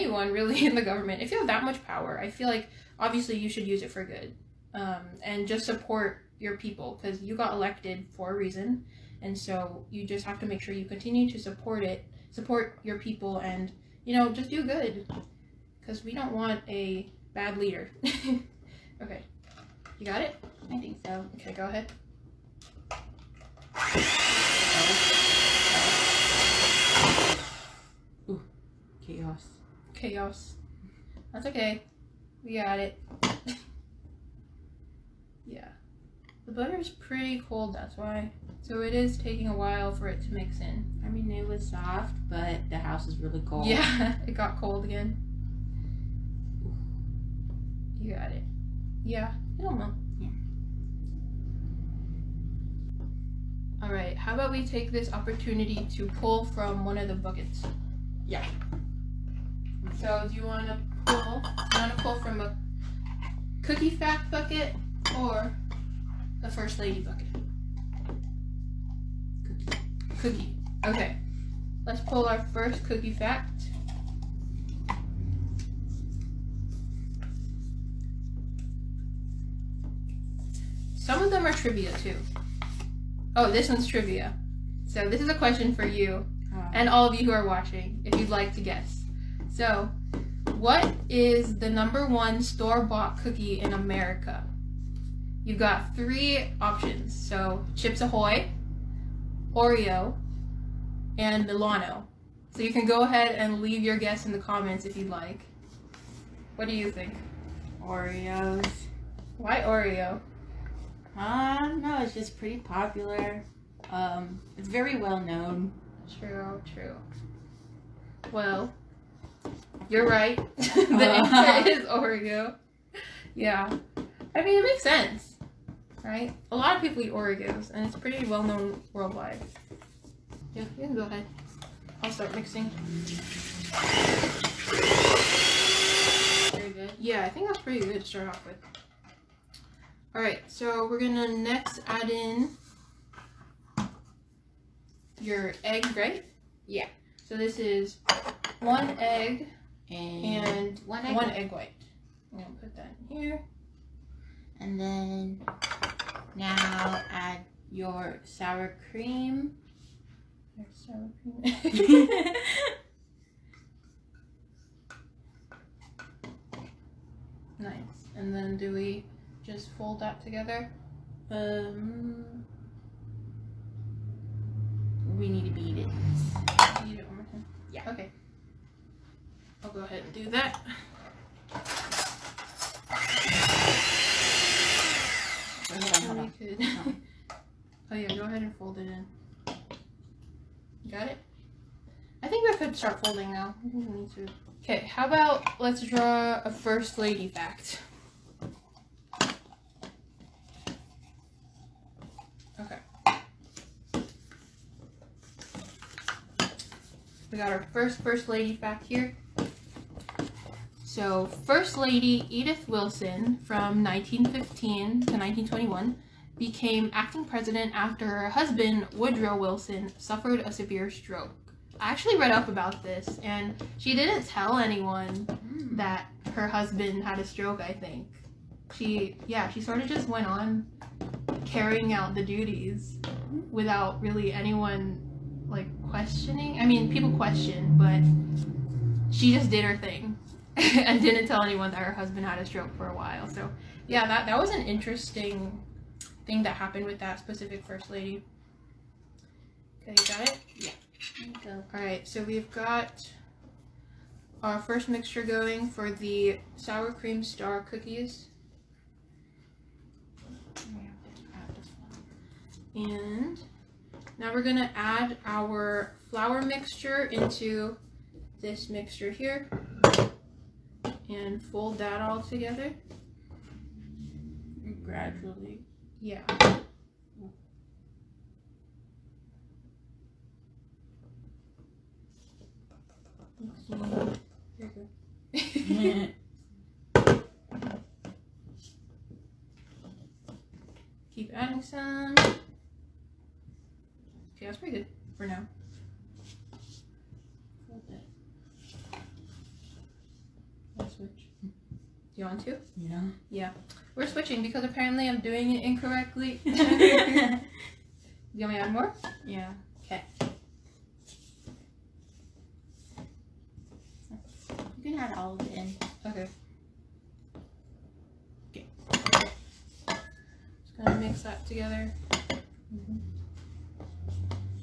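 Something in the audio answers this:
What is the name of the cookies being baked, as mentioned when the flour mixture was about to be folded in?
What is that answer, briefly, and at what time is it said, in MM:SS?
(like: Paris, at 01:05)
sour cream star cookies, at 04:16.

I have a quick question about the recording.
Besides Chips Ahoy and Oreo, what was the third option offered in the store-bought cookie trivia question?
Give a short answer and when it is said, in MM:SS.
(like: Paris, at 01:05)
Milano, at 01:41.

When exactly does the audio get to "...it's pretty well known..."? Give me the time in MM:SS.
02:07.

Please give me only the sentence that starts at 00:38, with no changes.
So it is taking a while for it to mix in.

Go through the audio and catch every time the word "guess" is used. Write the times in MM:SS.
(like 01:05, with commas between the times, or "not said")
01:28, 01:43.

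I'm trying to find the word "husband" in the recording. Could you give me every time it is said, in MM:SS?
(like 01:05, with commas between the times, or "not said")
03:38, 03:46, 04:01.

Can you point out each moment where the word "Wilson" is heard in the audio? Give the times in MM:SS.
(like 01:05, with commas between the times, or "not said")
03:32, 03:39.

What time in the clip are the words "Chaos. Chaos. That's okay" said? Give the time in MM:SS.
00:29.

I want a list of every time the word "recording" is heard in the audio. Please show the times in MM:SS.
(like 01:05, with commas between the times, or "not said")
not said.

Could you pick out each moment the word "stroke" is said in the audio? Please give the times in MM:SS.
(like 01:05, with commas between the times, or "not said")
03:40, 03:47, 04:02.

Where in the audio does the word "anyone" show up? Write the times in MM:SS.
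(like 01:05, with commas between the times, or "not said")
03:44, 03:54, 04:01.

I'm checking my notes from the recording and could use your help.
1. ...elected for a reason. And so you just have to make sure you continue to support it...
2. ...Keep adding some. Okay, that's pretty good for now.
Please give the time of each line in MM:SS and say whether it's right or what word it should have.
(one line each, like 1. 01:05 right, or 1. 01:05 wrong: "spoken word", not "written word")
1. 00:07 right
2. 04:51 right.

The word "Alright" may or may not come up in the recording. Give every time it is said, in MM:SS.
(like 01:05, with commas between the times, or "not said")
02:20, 04:11.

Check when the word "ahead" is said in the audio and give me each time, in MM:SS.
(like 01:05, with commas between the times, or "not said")
00:21, 01:43, 02:11, 02:59, 03:08.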